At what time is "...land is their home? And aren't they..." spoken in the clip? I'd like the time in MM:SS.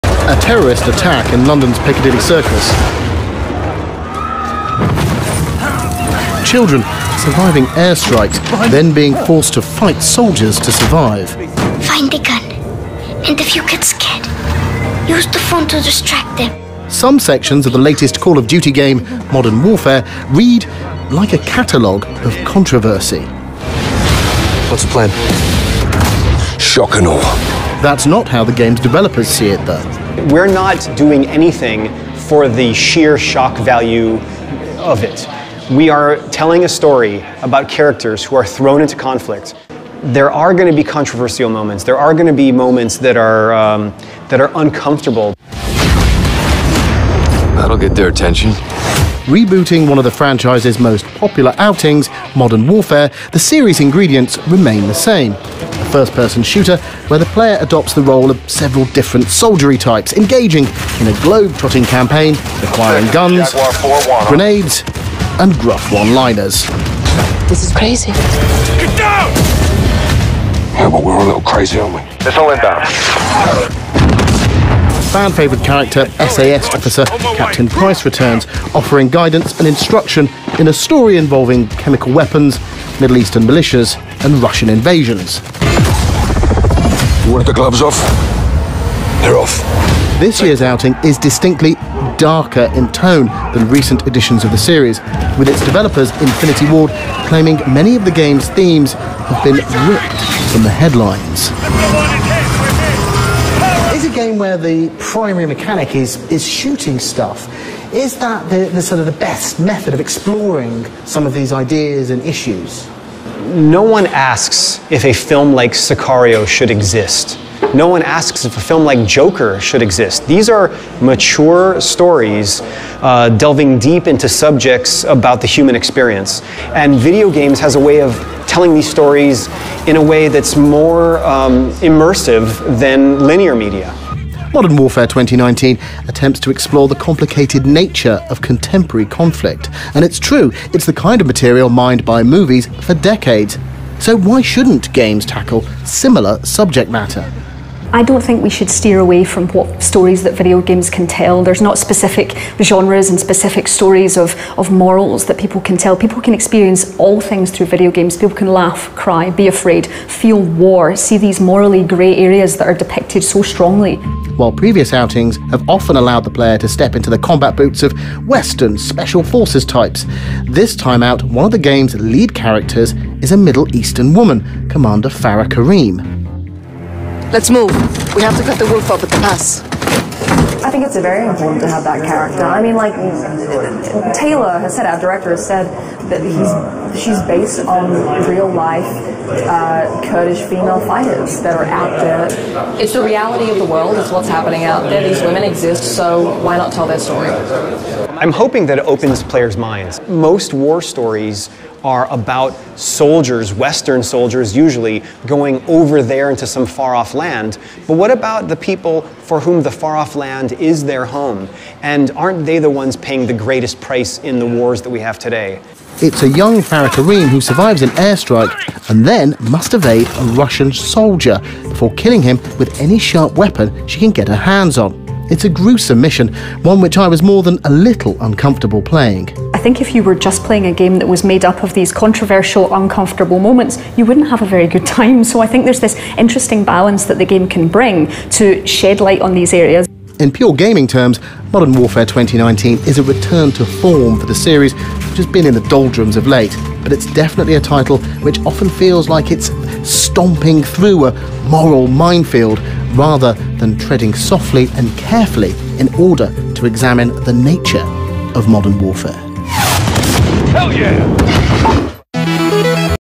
03:30.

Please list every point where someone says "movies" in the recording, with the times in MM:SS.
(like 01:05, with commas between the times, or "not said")
02:22.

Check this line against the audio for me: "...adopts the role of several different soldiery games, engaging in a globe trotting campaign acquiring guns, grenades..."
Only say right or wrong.
wrong.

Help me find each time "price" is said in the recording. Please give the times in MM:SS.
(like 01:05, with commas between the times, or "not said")
01:17, 03:33.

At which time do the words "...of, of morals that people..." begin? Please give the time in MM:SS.
02:34.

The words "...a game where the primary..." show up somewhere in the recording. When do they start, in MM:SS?
01:44.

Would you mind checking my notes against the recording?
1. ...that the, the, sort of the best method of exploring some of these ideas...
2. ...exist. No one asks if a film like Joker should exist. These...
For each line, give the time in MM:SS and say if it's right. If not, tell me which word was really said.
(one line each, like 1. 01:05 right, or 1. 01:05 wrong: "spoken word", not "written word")
1. 01:48 right
2. 01:56 right.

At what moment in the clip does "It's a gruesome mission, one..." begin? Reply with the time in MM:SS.
03:45.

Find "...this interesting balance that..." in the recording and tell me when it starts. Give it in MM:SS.
03:55.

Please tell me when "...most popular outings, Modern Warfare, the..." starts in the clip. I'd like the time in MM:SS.
00:50.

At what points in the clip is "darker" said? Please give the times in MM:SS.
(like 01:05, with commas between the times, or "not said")
01:32.